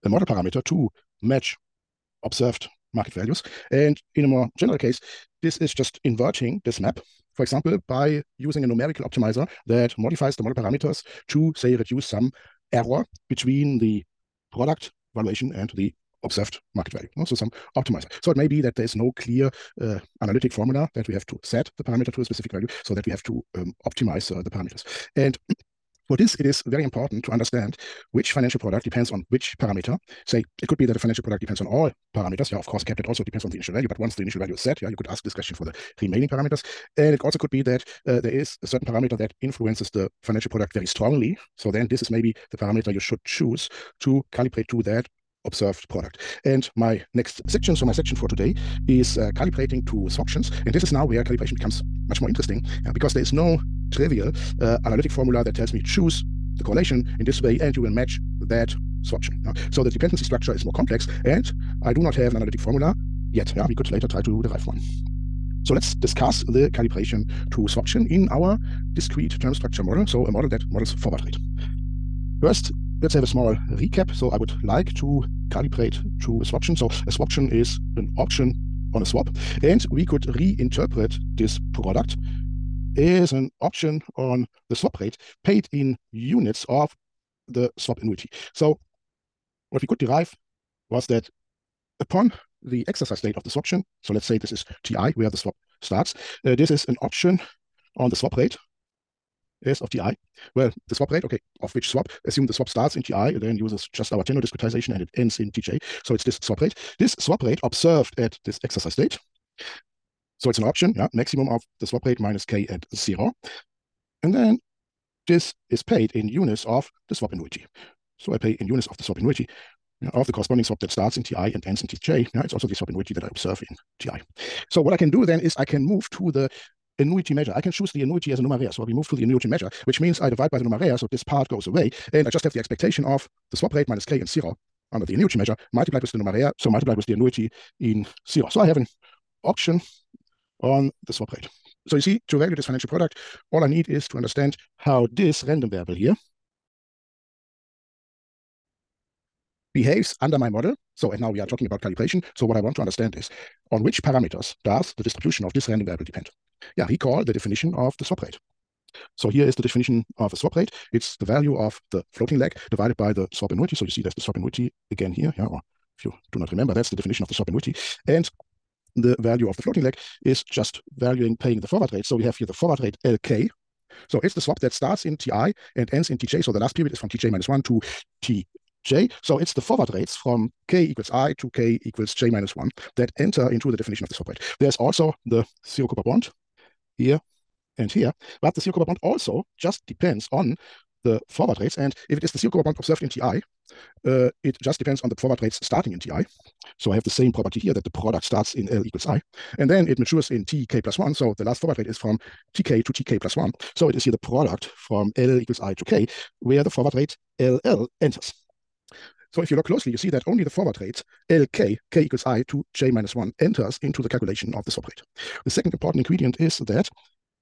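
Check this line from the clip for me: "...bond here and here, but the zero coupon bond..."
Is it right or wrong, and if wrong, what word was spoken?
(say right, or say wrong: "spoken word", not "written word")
right.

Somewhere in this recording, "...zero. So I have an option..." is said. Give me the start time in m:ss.
2:18.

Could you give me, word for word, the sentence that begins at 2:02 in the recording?
Yeah, it's also the swap annuity that I observe in TI.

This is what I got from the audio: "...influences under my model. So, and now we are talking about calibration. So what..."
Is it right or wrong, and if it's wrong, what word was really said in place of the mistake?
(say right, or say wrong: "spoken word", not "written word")
wrong: "behaves", not "influences".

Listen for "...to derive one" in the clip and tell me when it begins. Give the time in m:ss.
1:04.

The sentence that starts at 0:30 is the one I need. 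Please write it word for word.
Say, it could be that a financial product depends on all parameters.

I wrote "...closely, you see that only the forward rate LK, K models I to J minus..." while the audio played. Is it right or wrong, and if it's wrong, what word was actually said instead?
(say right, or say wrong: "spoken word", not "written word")
wrong: "equals", not "models".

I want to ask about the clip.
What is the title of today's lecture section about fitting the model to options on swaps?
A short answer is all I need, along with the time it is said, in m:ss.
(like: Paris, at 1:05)
Calibrating to swaptions, at 0:49.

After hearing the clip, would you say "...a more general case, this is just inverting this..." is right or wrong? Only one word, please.
right.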